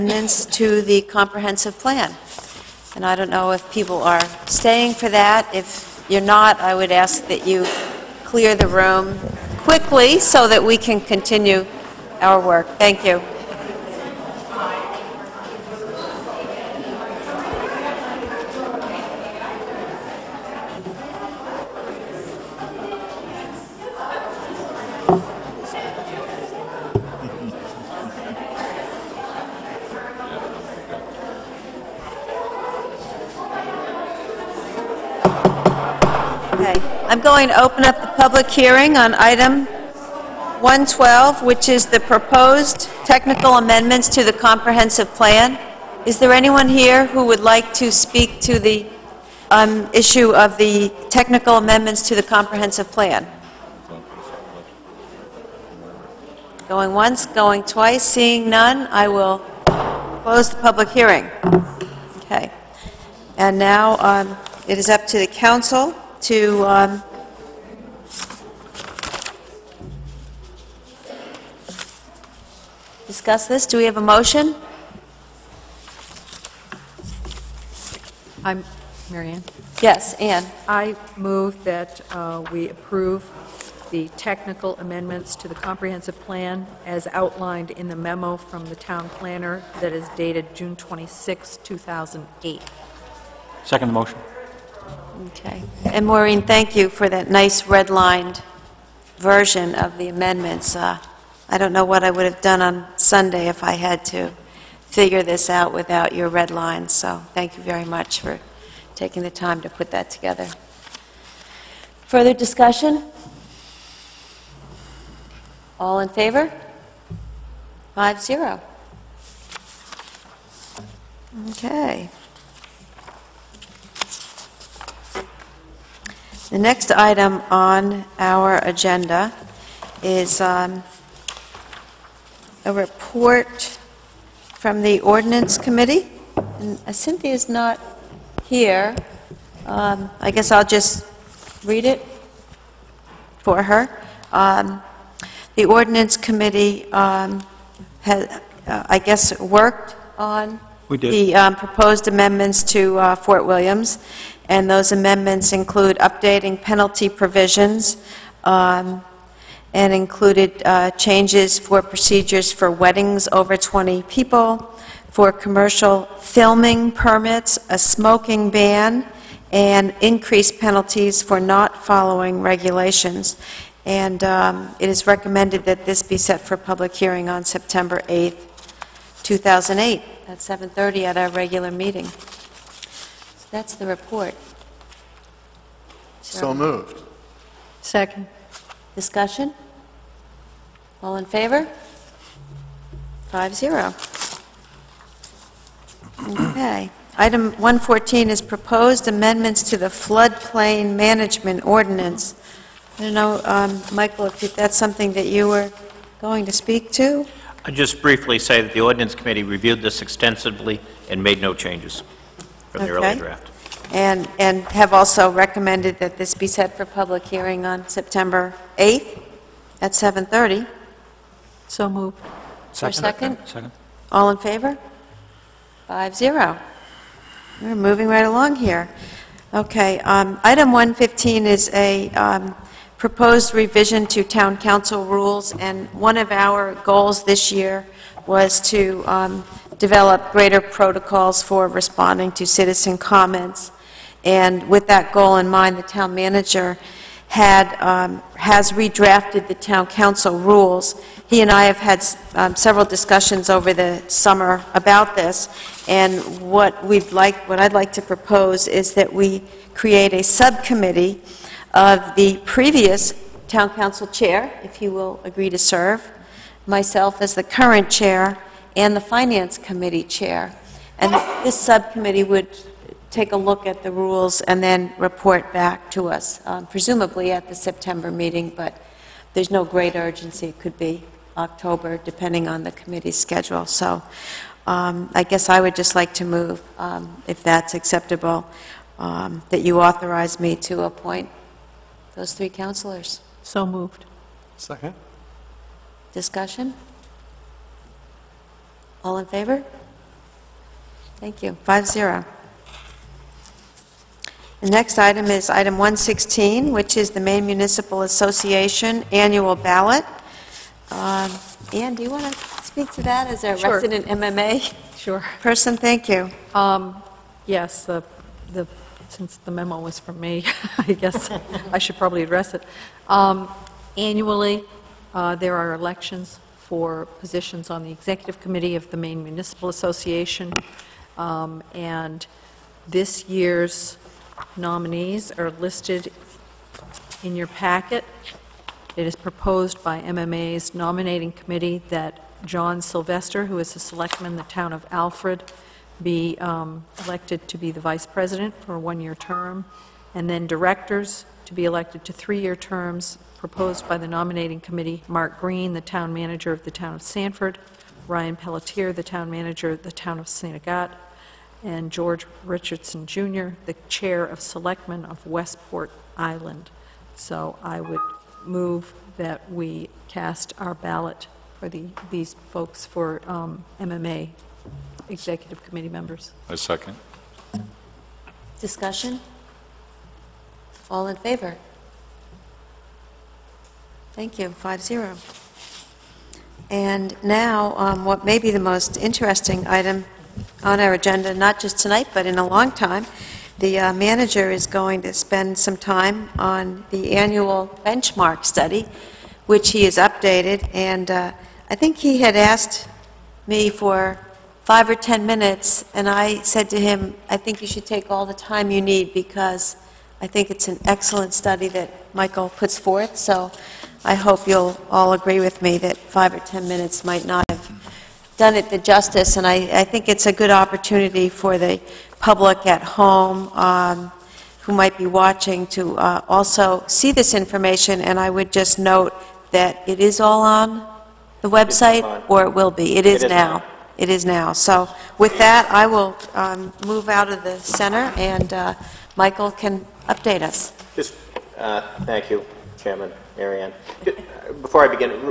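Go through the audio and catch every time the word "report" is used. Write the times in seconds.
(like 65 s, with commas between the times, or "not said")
132 s, 183 s, 274 s.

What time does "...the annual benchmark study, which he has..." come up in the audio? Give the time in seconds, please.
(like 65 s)
396 s.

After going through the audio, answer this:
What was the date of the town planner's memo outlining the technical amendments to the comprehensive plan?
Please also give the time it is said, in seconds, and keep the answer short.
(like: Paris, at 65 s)
June 26, 2008, at 90 s.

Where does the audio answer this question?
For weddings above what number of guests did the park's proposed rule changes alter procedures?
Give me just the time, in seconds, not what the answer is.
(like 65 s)
163 s.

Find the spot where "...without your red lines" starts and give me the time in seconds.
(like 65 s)
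105 s.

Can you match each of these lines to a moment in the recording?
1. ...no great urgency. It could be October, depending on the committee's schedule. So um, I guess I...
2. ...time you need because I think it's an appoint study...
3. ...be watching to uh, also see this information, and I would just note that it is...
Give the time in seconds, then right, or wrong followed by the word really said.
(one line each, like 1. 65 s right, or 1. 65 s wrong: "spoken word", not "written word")
1. 279 s right
2. 408 s wrong: "excellent", not "appoint"
3. 424 s right.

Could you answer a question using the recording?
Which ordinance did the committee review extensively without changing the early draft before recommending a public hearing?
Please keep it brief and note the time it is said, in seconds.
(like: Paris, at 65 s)
Floodplain management ordinance, at 199 s.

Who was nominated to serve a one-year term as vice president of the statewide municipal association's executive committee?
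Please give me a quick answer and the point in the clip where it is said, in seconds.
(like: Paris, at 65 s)
John Sylvester, at 342 s.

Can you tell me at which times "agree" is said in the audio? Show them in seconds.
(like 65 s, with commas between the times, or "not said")
265 s, 415 s.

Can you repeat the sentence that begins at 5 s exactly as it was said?
If you're not, I would ask that you clear the room quickly so that we can continue our work.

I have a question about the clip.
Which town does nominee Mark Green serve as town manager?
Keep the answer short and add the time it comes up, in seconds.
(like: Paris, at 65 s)
Sanford, at 357 s.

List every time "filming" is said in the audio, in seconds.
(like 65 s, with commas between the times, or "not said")
166 s.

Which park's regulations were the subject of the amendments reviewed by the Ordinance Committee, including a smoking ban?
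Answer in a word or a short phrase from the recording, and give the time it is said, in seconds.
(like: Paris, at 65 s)
Fort Williams, at 153 s.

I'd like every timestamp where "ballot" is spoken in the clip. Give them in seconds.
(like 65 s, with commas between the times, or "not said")
309 s, 370 s.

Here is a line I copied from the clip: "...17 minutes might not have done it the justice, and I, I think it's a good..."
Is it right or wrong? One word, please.
wrong.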